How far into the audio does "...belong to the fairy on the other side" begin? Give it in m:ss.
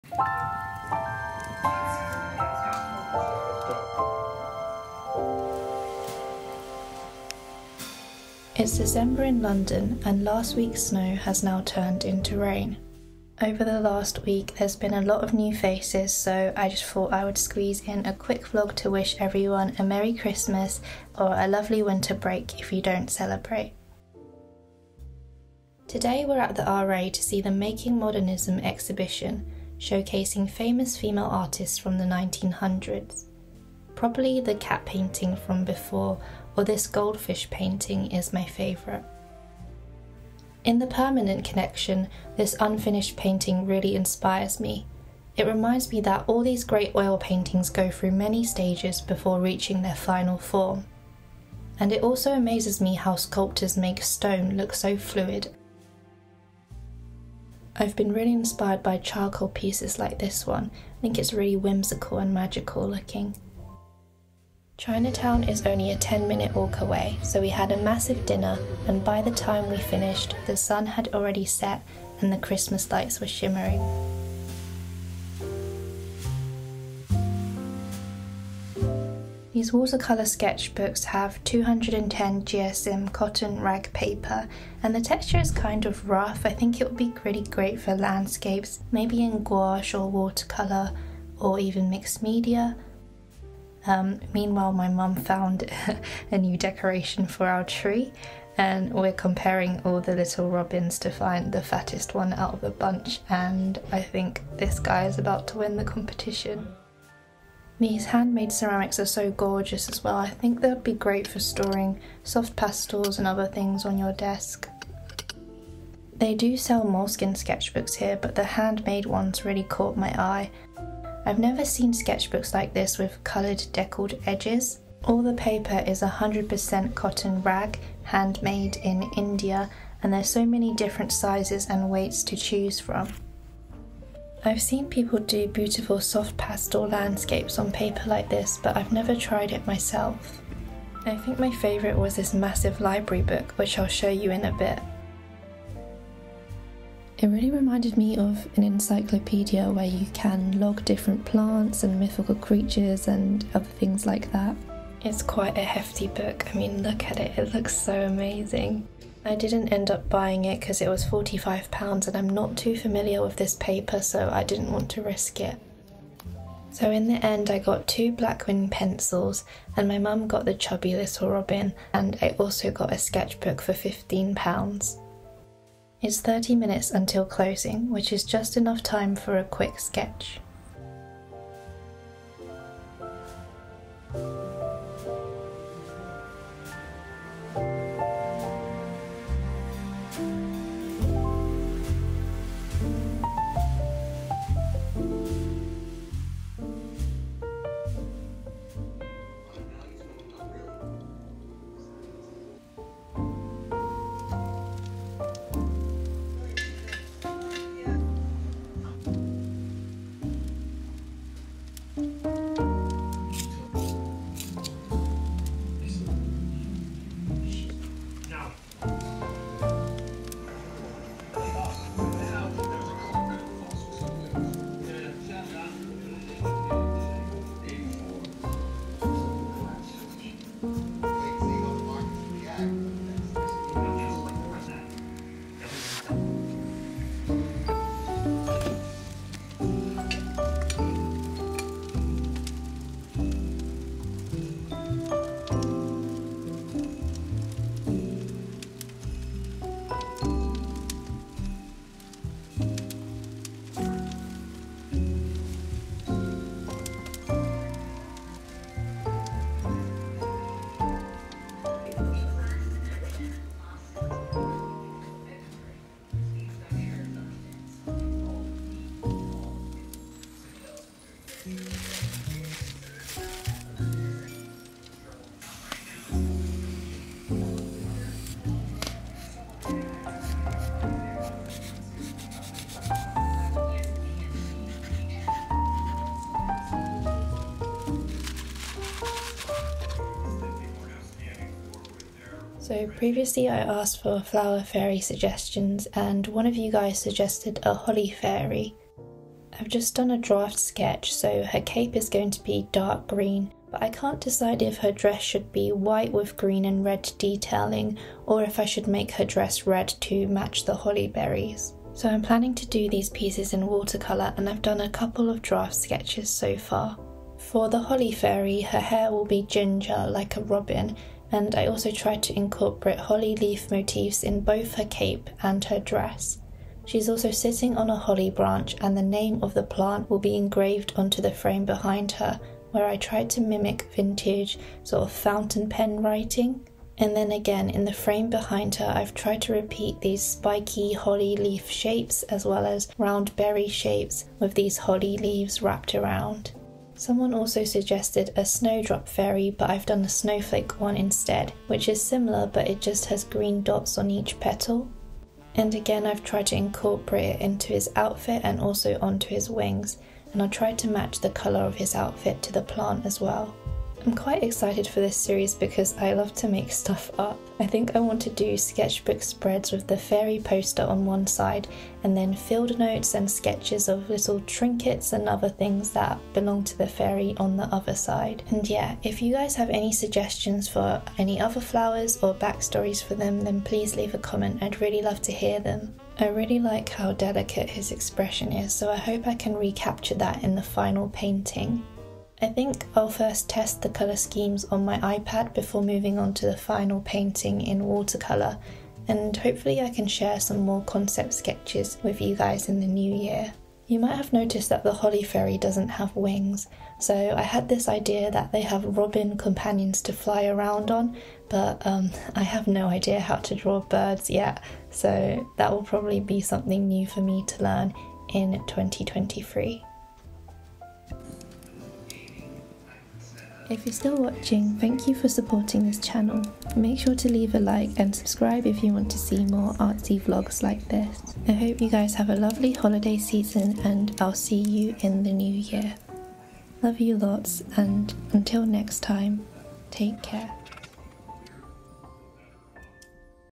6:16.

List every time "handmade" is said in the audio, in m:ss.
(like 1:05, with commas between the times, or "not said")
1:48, 1:58, 2:08.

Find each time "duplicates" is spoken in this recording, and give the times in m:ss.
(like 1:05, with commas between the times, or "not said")
not said.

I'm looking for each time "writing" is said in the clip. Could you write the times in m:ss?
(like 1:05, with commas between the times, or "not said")
5:36.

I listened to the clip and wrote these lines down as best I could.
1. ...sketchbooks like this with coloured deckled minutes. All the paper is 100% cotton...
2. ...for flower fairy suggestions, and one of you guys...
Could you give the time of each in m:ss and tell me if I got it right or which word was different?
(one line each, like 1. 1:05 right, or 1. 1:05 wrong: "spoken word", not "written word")
1. 2:01 wrong: "edges", not "minutes"
2. 4:54 right.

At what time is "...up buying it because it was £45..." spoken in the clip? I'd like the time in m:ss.
2:39.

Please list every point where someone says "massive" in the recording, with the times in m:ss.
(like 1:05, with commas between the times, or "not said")
1:07, 2:22.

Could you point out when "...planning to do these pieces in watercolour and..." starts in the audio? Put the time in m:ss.
5:12.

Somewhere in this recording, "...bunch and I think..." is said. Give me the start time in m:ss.
1:42.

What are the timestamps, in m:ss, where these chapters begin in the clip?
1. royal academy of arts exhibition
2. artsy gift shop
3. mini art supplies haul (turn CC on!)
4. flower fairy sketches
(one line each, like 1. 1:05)
1. 0:25
2. 1:19
3. 3:20
4. 4:53.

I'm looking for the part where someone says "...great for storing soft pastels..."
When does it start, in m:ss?
1:50.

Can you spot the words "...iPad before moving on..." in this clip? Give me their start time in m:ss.
6:35.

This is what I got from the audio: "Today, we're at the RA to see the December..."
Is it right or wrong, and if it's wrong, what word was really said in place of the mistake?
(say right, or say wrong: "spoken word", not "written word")
wrong: "Making", not "December".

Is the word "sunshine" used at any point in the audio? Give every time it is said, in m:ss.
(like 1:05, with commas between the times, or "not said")
not said.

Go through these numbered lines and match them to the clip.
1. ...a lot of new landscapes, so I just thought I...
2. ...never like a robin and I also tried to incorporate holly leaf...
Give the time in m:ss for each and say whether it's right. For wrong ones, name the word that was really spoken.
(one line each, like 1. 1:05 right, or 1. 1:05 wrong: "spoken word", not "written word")
1. 0:14 wrong: "faces", not "landscapes"
2. 5:19 wrong: "ginger", not "never".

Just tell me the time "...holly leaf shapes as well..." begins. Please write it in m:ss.
5:40.